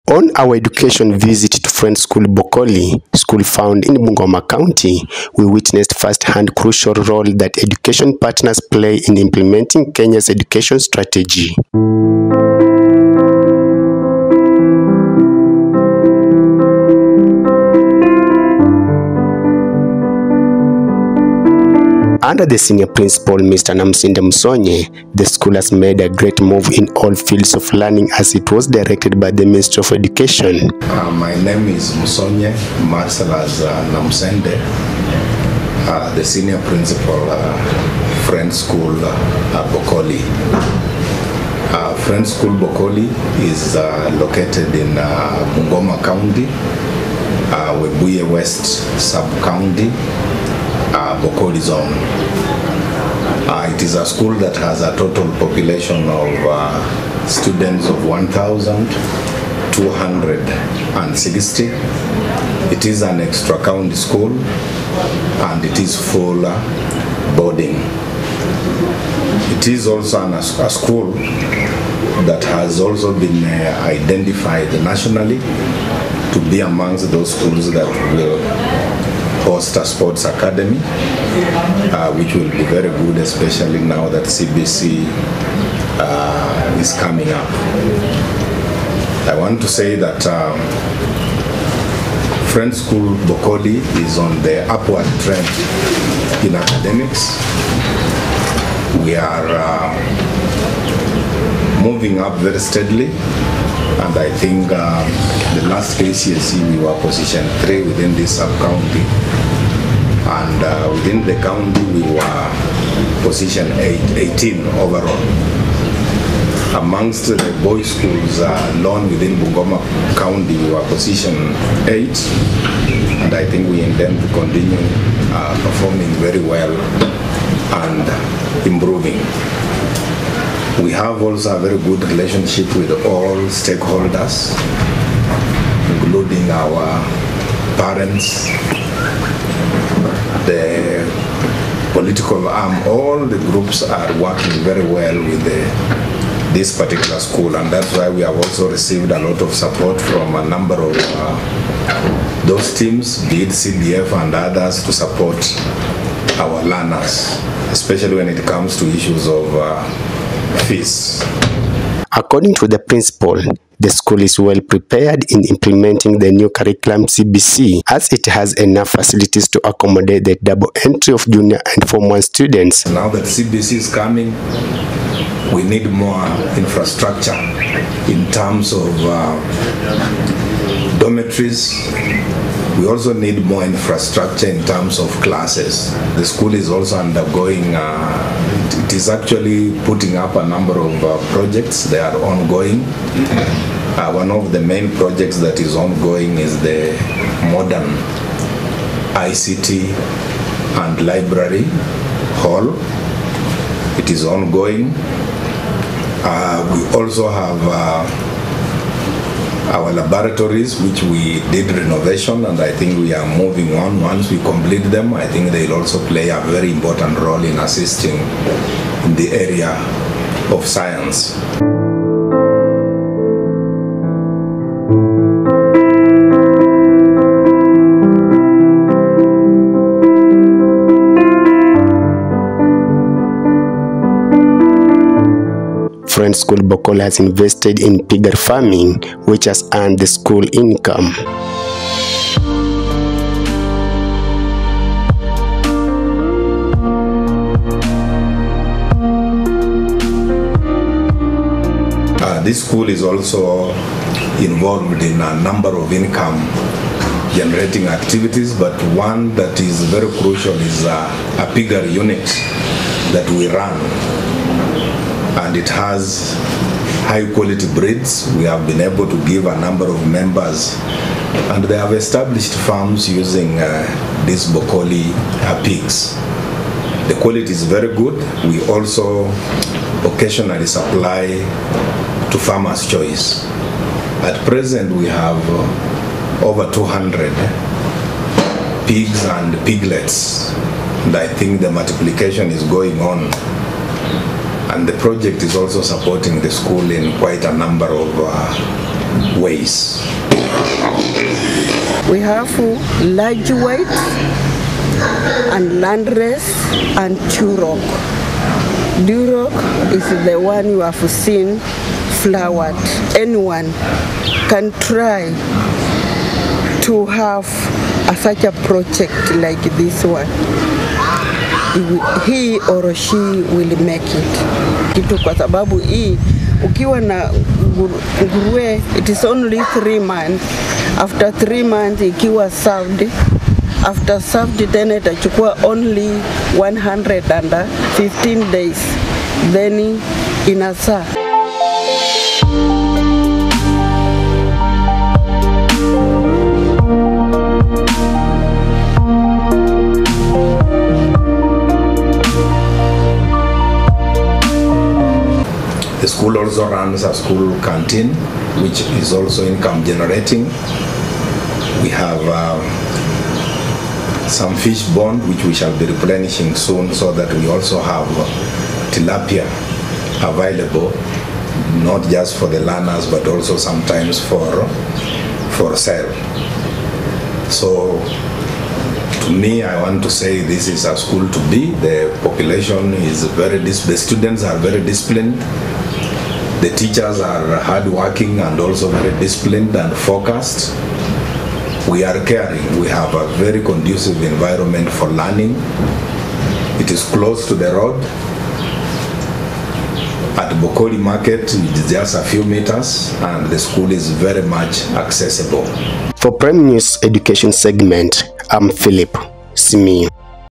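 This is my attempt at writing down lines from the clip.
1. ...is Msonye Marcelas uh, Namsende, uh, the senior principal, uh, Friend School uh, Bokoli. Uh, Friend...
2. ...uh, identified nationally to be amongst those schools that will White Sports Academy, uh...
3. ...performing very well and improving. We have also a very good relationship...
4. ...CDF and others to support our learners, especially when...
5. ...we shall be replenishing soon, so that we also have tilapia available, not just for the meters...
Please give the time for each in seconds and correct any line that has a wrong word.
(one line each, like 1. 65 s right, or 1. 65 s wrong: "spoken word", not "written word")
1. 31 s right
2. 73 s wrong: "Costa", not "White"
3. 125 s right
4. 153 s right
5. 365 s wrong: "learners", not "meters".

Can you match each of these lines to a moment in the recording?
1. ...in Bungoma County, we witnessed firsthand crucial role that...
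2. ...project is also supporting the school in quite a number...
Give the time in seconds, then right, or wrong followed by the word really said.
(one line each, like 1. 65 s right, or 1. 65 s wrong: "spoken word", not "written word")
1. 3 s right
2. 294 s right.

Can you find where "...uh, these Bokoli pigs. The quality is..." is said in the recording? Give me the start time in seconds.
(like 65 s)
273 s.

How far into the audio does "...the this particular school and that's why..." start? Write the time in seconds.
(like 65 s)
145 s.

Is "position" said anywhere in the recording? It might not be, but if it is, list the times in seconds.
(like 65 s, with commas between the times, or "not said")
107 s, 113 s, 120 s.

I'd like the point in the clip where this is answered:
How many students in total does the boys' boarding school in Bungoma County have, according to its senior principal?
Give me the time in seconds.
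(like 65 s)
58 s.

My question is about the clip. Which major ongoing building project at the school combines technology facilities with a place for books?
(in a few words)
Modern ICT and library hall.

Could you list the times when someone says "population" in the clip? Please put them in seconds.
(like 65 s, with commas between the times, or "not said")
55 s, 382 s.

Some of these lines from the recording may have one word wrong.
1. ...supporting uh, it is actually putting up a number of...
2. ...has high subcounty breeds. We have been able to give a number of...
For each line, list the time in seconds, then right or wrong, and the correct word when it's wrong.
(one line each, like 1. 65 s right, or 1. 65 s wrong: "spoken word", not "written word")
1. 186 s wrong: "undergoing", not "supporting"
2. 265 s wrong: "quality", not "subcounty".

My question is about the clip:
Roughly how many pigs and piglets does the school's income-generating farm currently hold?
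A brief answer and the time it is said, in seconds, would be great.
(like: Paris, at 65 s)
Over 200, at 286 s.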